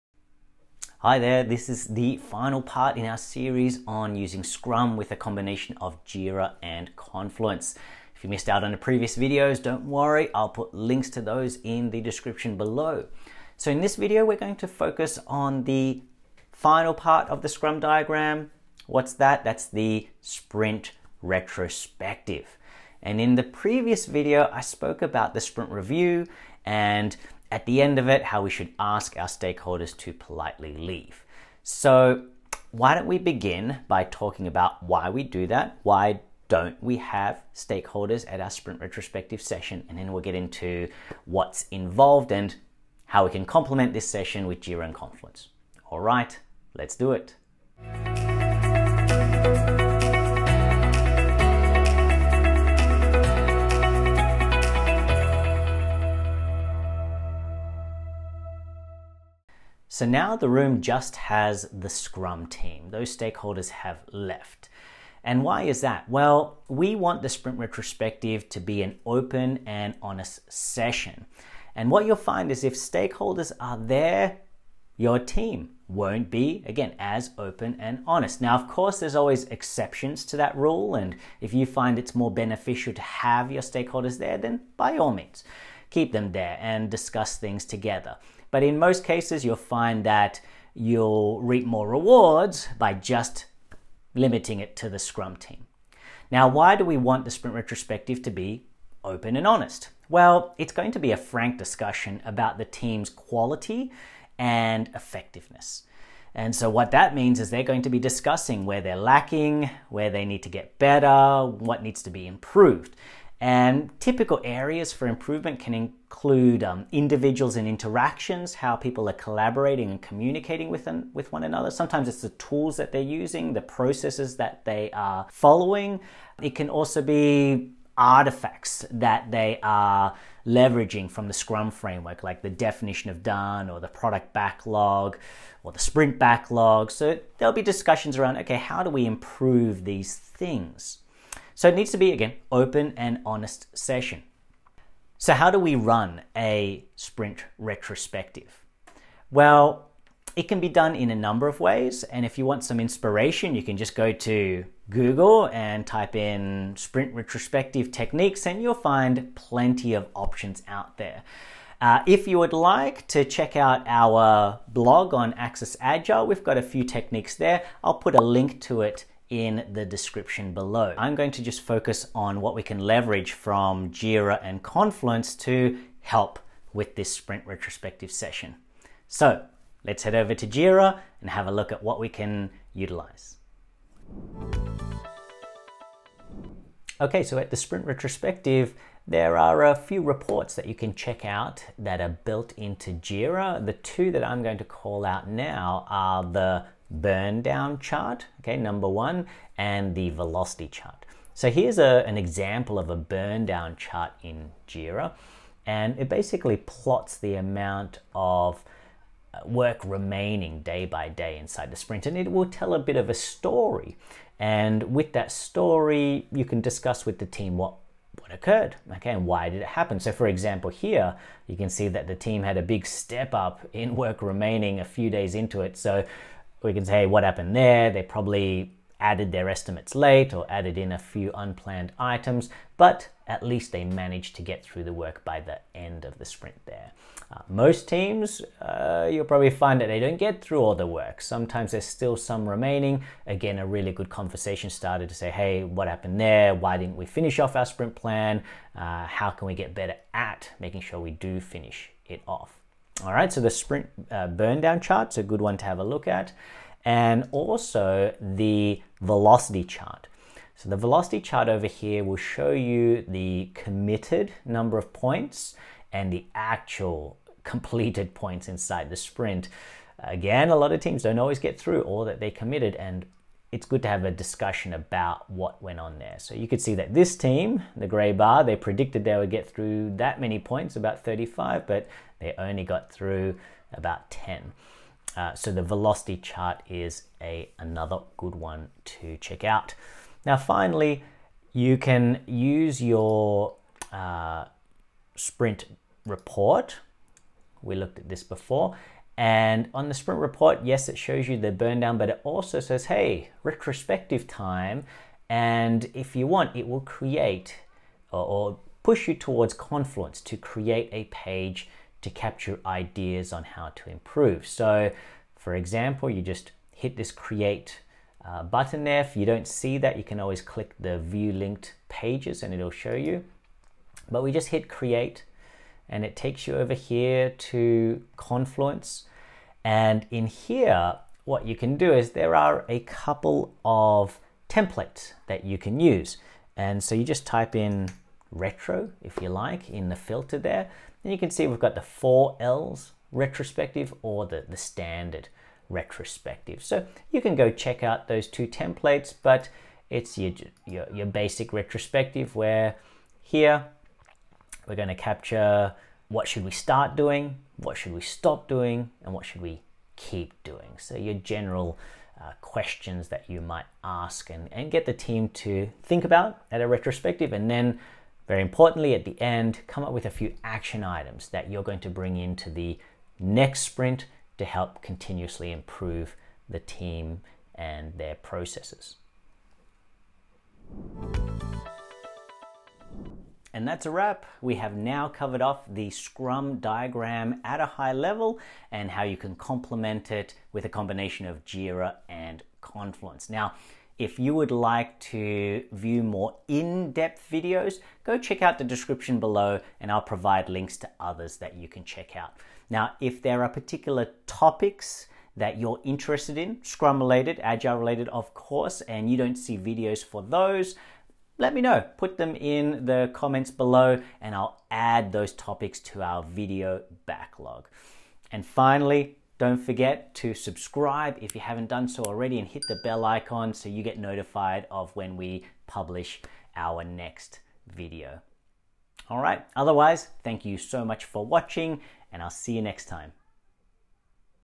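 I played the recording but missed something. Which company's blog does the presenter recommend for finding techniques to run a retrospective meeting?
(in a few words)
AxisAgile.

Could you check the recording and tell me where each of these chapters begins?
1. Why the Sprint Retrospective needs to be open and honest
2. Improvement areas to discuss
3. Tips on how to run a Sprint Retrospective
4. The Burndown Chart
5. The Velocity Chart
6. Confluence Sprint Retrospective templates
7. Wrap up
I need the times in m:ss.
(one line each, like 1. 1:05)
1. 0:58
2. 1:58
3. 2:27
4. 3:04
5. 4:18
6. 5:06
7. 6:23.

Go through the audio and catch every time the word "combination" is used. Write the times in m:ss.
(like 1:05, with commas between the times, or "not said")
0:05, 6:30.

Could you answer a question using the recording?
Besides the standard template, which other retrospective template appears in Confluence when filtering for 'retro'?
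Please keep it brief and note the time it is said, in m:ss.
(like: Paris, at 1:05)
four L's retrospective, at 5:41.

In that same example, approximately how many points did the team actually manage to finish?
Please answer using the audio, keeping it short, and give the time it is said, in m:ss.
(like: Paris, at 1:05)
10, at 4:43.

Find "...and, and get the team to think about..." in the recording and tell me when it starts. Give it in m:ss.
6:04.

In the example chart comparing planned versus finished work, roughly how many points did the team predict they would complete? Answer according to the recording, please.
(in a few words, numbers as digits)
35.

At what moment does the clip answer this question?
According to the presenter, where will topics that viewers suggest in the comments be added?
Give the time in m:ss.
6:56.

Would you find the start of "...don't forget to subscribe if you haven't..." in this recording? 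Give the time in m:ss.
6:59.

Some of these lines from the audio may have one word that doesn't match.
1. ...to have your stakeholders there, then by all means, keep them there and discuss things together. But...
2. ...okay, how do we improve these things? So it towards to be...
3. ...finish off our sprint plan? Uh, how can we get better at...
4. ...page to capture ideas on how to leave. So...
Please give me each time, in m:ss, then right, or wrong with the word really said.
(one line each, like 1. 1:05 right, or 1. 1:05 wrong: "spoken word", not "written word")
1. 1:22 right
2. 2:18 wrong: "needs", not "towards"
3. 4:07 right
4. 5:11 wrong: "improve", not "leave".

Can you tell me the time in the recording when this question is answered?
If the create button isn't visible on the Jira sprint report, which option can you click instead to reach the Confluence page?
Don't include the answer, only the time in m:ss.
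5:20.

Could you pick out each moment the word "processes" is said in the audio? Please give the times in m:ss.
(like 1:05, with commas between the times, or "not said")
2:03, 6:18.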